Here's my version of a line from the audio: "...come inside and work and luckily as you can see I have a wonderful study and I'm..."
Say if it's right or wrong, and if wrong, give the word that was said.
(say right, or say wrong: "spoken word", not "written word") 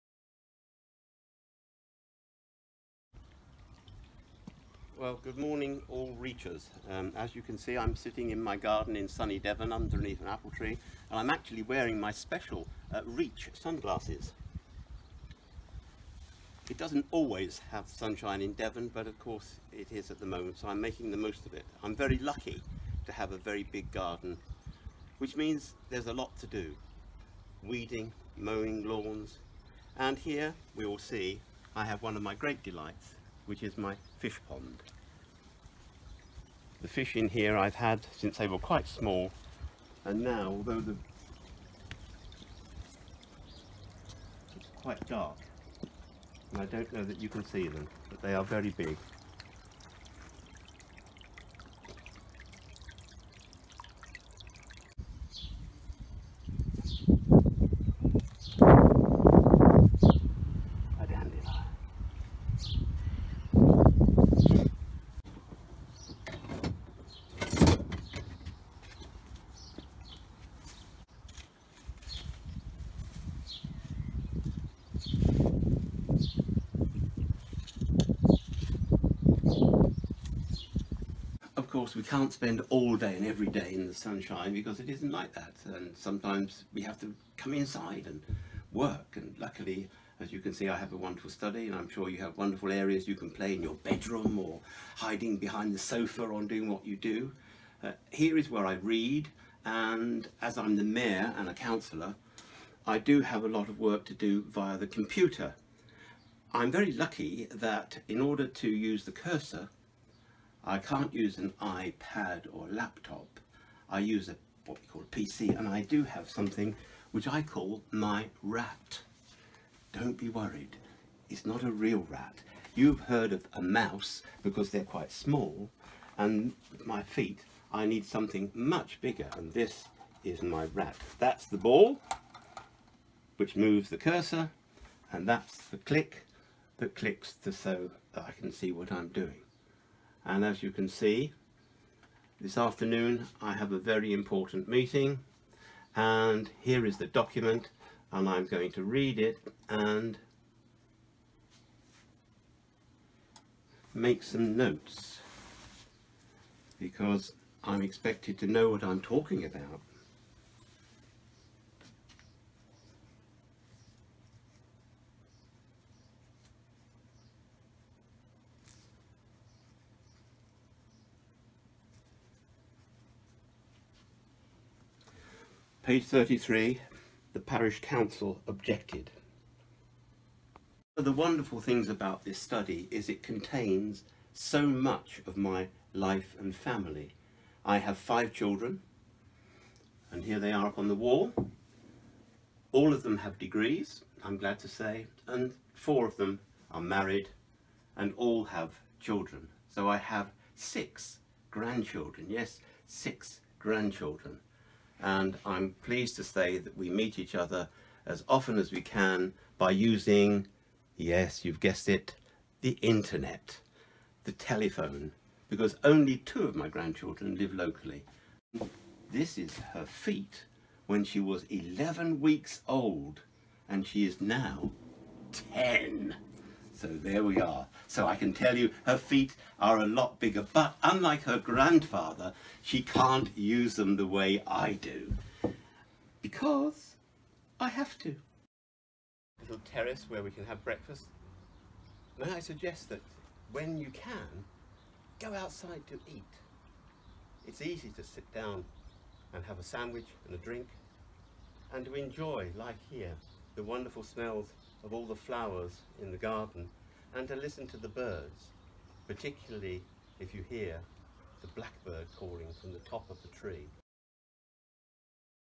right.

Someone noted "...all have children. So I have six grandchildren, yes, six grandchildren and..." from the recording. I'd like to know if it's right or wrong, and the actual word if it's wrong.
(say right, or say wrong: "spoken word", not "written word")
right.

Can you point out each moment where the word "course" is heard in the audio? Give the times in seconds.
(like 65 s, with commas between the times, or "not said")
19 s, 81 s.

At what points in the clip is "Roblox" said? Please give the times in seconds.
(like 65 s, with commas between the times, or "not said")
not said.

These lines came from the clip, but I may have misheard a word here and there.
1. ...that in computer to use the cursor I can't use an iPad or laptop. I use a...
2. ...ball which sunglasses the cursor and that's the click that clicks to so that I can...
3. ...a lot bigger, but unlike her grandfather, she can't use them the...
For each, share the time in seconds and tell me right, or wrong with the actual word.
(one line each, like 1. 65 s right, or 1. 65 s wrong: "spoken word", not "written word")
1. 107 s wrong: "order", not "computer"
2. 131 s wrong: "moves", not "sunglasses"
3. 229 s right.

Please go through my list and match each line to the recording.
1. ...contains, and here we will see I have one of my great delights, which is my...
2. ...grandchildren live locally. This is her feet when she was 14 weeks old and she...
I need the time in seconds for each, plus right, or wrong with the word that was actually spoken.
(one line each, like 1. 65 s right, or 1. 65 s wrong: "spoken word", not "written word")
1. 28 s wrong: "lawns", not "contains"
2. 216 s wrong: "11", not "14".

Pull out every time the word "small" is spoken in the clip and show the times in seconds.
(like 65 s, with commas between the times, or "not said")
38 s, 125 s.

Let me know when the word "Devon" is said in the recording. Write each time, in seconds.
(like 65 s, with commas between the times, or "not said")
9 s, 18 s.